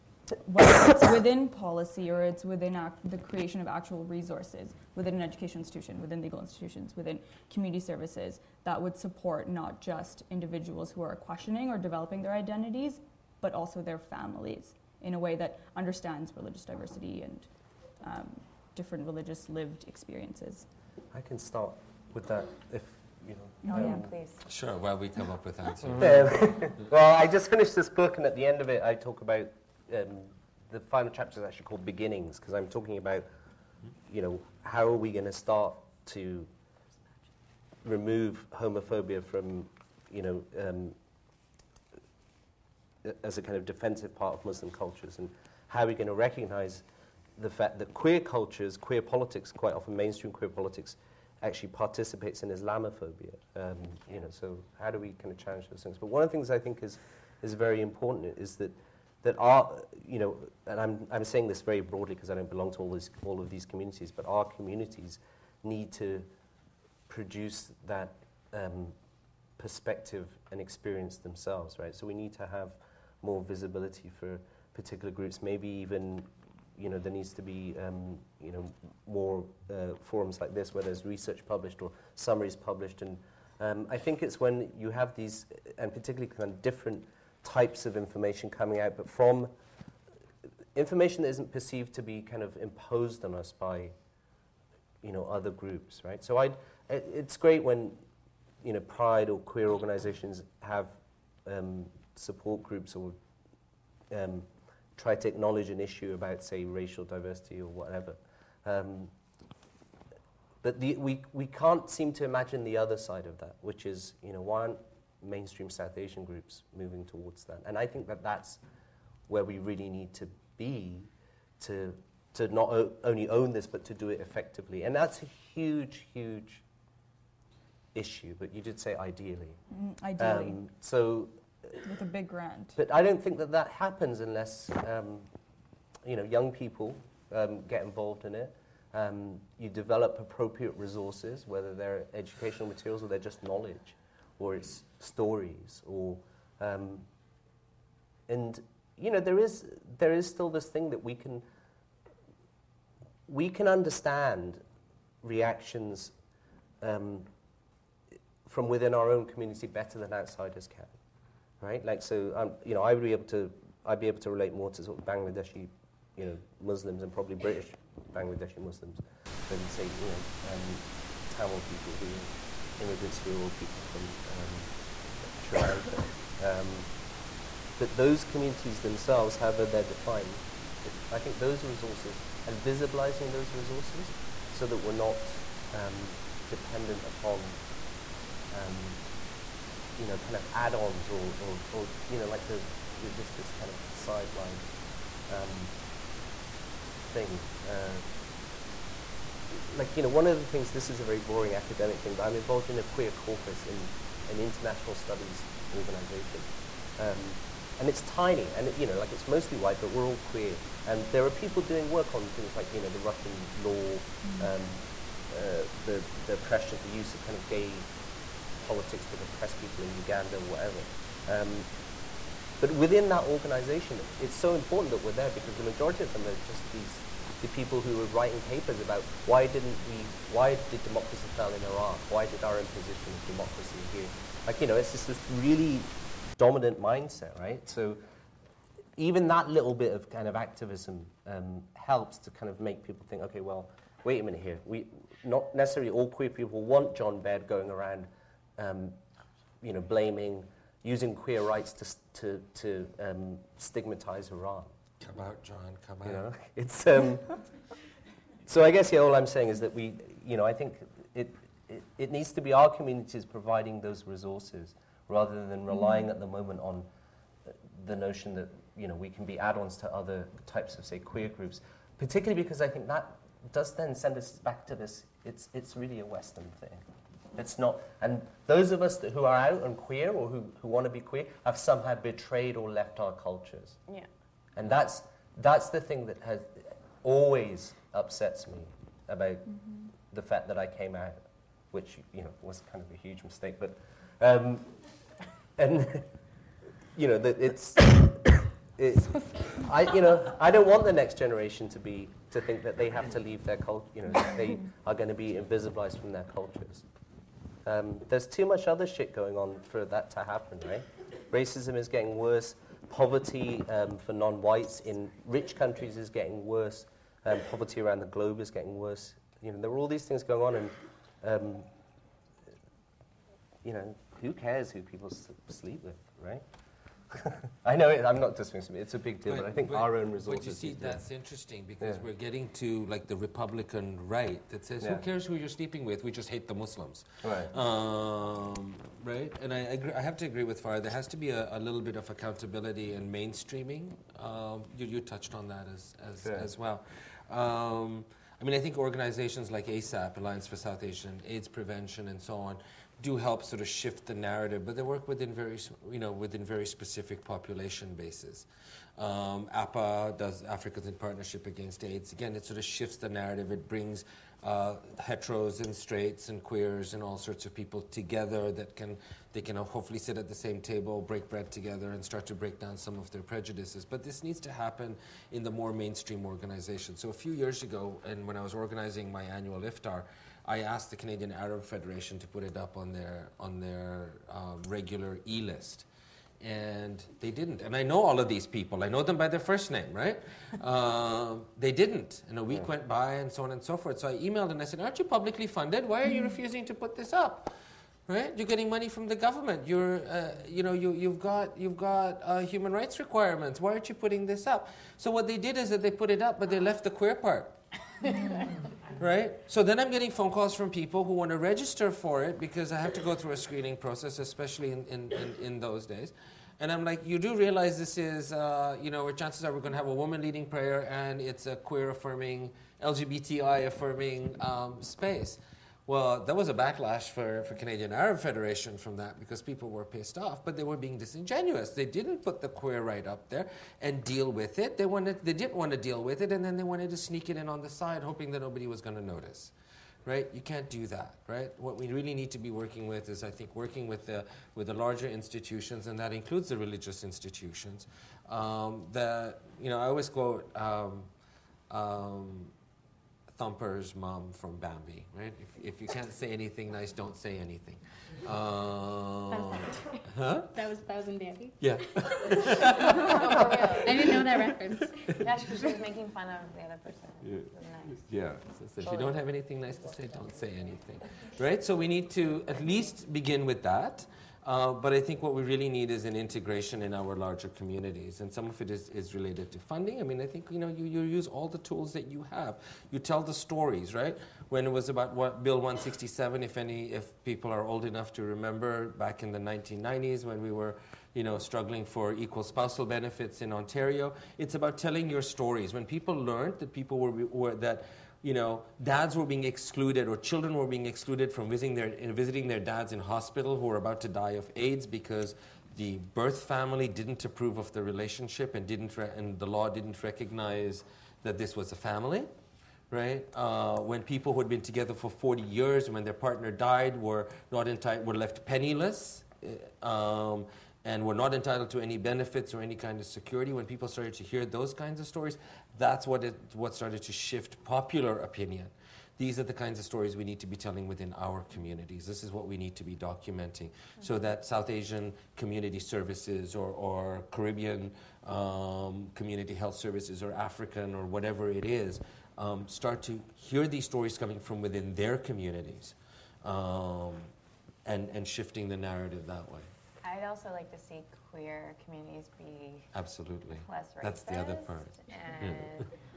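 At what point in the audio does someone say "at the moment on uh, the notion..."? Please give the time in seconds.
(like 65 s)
266 s.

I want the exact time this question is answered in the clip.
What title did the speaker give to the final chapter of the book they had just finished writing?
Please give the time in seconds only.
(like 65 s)
31 s.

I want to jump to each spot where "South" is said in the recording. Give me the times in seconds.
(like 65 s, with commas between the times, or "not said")
115 s, 350 s, 534 s.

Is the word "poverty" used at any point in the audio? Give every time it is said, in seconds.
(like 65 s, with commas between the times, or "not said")
312 s, 317 s.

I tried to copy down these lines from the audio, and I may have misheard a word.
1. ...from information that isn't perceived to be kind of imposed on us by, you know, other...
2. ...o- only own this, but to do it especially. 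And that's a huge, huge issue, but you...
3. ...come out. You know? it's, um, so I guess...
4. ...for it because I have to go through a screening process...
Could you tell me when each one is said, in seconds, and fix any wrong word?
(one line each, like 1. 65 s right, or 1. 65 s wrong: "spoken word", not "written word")
1. 89 s right
2. 122 s wrong: "effectively", not "especially"
3. 255 s right
4. 411 s right.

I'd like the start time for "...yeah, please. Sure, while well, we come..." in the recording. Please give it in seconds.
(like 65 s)
23 s.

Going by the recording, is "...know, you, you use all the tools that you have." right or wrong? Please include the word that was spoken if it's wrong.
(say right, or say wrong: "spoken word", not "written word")
right.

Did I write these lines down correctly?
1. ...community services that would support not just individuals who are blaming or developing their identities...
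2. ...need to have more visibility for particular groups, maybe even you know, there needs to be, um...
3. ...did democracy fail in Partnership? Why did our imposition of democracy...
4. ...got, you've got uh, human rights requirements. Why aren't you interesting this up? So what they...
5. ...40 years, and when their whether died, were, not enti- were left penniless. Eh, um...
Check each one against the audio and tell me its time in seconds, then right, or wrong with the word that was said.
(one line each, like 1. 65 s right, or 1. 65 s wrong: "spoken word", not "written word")
1. 7 s wrong: "questioning", not "blaming"
2. 72 s right
3. 230 s wrong: "Iraq", not "Partnership"
4. 401 s wrong: "putting", not "interesting"
5. 515 s wrong: "partner", not "whether".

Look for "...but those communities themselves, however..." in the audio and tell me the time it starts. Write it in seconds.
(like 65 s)
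177 s.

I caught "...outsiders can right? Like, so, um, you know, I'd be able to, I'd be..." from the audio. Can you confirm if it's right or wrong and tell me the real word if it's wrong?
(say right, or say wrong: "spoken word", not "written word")
right.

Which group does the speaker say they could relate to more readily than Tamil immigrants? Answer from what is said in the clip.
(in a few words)
British Bangladeshi Muslims.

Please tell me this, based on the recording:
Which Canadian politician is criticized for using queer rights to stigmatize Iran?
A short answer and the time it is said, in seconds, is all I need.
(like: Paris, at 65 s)
John Baird, at 246 s.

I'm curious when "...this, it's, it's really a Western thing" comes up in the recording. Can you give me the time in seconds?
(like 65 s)
274 s.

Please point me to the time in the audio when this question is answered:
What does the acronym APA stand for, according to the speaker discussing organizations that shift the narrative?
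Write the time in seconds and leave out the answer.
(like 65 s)
360 s.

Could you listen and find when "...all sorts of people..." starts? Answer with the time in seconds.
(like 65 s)
367 s.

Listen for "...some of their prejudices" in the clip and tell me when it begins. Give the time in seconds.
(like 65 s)
372 s.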